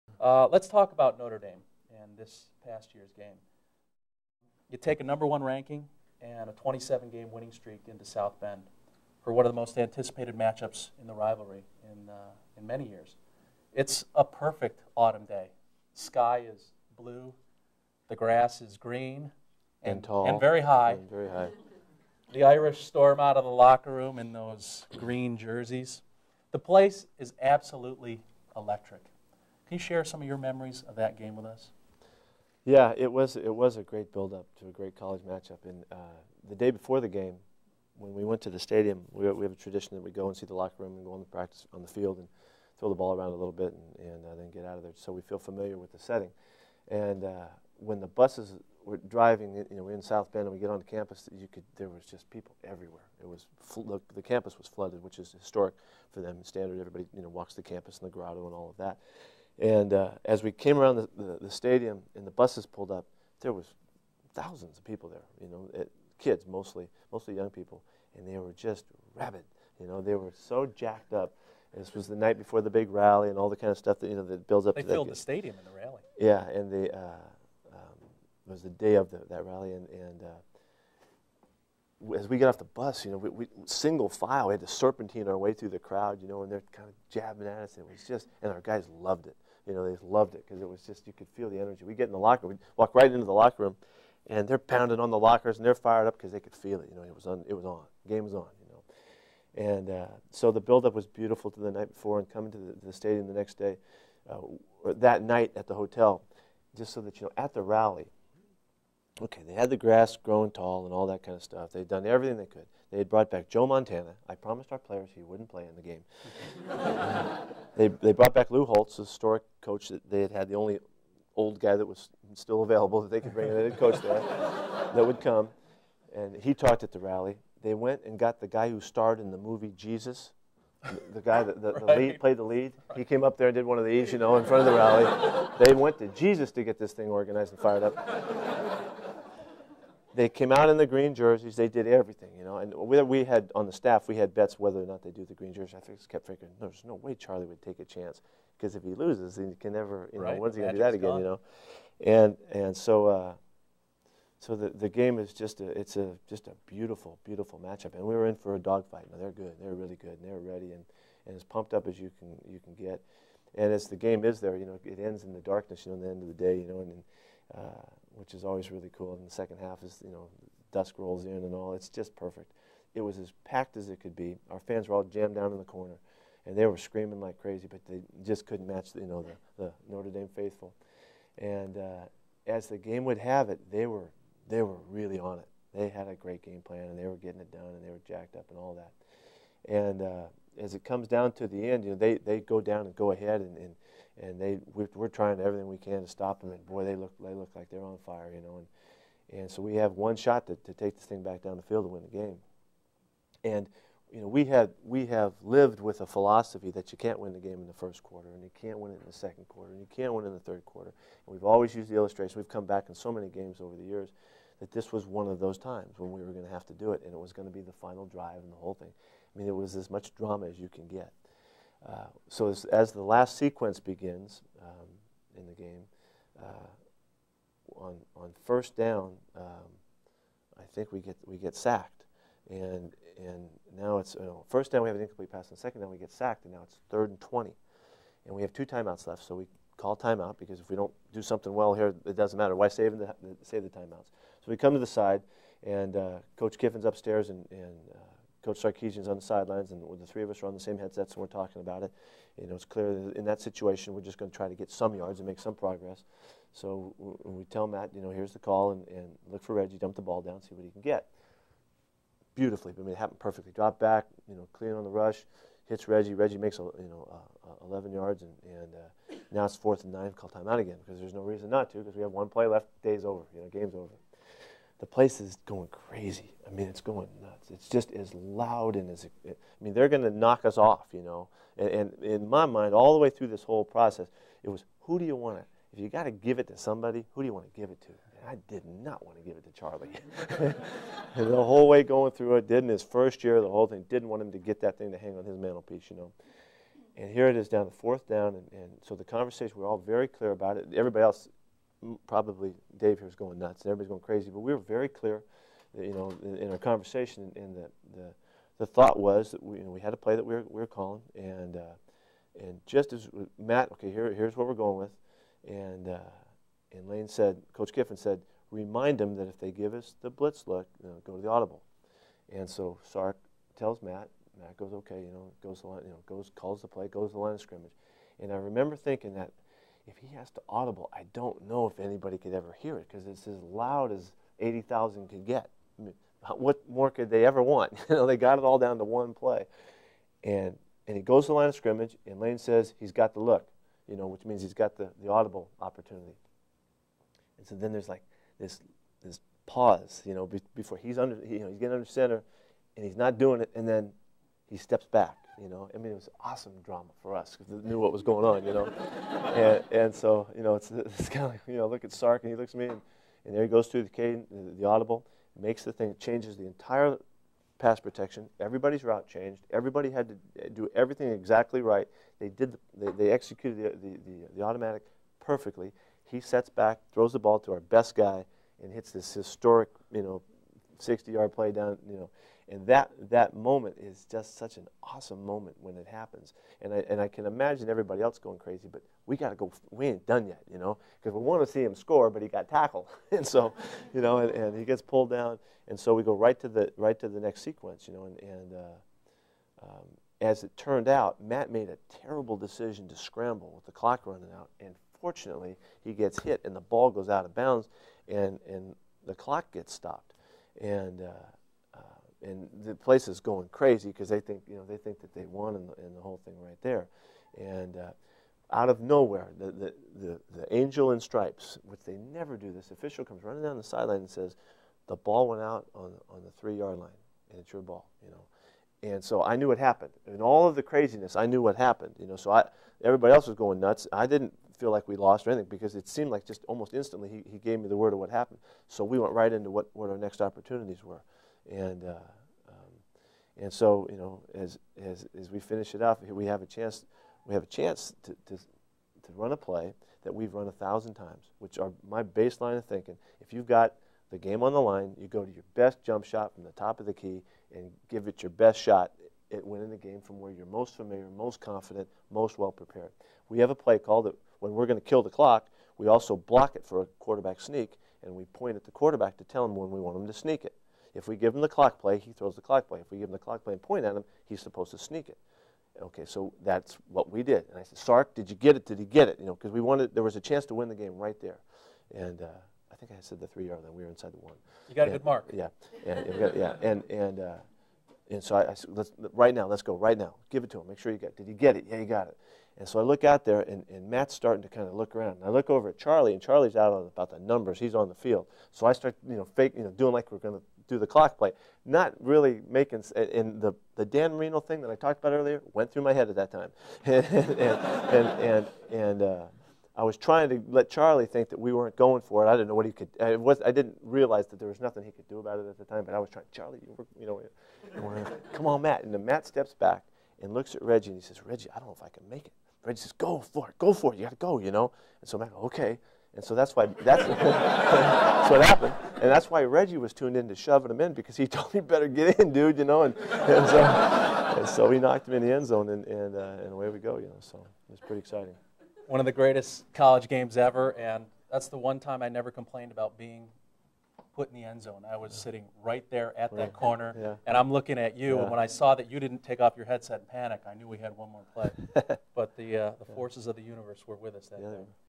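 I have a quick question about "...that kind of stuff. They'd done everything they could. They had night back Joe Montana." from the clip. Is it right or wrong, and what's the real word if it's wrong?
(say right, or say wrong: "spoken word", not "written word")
wrong: "brought", not "night".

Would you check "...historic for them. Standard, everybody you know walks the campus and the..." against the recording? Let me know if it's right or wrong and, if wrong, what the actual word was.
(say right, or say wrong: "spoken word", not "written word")
right.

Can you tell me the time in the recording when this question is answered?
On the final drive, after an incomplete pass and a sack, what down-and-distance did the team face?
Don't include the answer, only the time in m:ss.
3:56.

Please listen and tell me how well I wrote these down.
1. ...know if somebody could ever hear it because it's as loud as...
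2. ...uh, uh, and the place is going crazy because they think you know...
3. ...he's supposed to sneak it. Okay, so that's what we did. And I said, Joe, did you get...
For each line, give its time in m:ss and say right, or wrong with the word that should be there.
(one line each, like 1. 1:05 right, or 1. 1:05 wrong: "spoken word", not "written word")
1. 5:31 wrong: "anybody", not "somebody"
2. 6:51 right
3. 7:54 wrong: "Sark", not "Joe".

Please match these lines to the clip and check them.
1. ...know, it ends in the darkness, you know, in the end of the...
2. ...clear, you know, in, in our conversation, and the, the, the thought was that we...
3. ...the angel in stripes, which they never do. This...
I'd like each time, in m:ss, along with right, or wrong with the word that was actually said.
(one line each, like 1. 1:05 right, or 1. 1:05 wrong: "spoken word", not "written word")
1. 2:44 right
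2. 5:04 right
3. 7:00 right.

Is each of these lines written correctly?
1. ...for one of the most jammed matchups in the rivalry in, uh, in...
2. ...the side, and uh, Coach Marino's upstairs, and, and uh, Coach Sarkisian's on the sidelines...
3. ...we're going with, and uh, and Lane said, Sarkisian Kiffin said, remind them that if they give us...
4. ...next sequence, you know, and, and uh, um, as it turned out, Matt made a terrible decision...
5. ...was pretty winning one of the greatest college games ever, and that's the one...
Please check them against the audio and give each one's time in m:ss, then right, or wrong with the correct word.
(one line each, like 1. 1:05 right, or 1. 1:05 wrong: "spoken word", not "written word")
1. 0:09 wrong: "anticipated", not "jammed"
2. 4:04 wrong: "Kiffin", not "Marino"
3. 5:14 wrong: "Coach", not "Sarkisian"
4. 6:37 right
5. 8:57 wrong: "exciting", not "winning".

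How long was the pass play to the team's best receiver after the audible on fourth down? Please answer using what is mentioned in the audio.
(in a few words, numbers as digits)
60 yards.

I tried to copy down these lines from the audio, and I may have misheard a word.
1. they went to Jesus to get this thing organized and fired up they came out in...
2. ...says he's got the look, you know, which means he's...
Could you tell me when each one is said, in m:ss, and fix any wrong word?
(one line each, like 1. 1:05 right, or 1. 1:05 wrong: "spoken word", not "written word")
1. 2:15 right
2. 5:42 right.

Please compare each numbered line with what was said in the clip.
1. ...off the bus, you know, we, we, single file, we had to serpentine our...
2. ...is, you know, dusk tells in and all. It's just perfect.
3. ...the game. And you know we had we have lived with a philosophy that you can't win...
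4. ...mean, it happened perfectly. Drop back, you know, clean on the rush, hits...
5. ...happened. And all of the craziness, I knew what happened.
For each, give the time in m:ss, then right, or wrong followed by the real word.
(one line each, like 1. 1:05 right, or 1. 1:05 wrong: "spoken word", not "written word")
1. 1:22 right
2. 2:49 wrong: "rolls", not "tells"
3. 3:22 right
4. 4:22 right
5. 7:09 right.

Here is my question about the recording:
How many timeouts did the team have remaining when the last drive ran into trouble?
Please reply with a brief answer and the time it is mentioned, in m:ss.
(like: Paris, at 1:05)
2, at 3:58.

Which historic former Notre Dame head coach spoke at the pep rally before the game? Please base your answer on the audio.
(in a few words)
Lou Holtz.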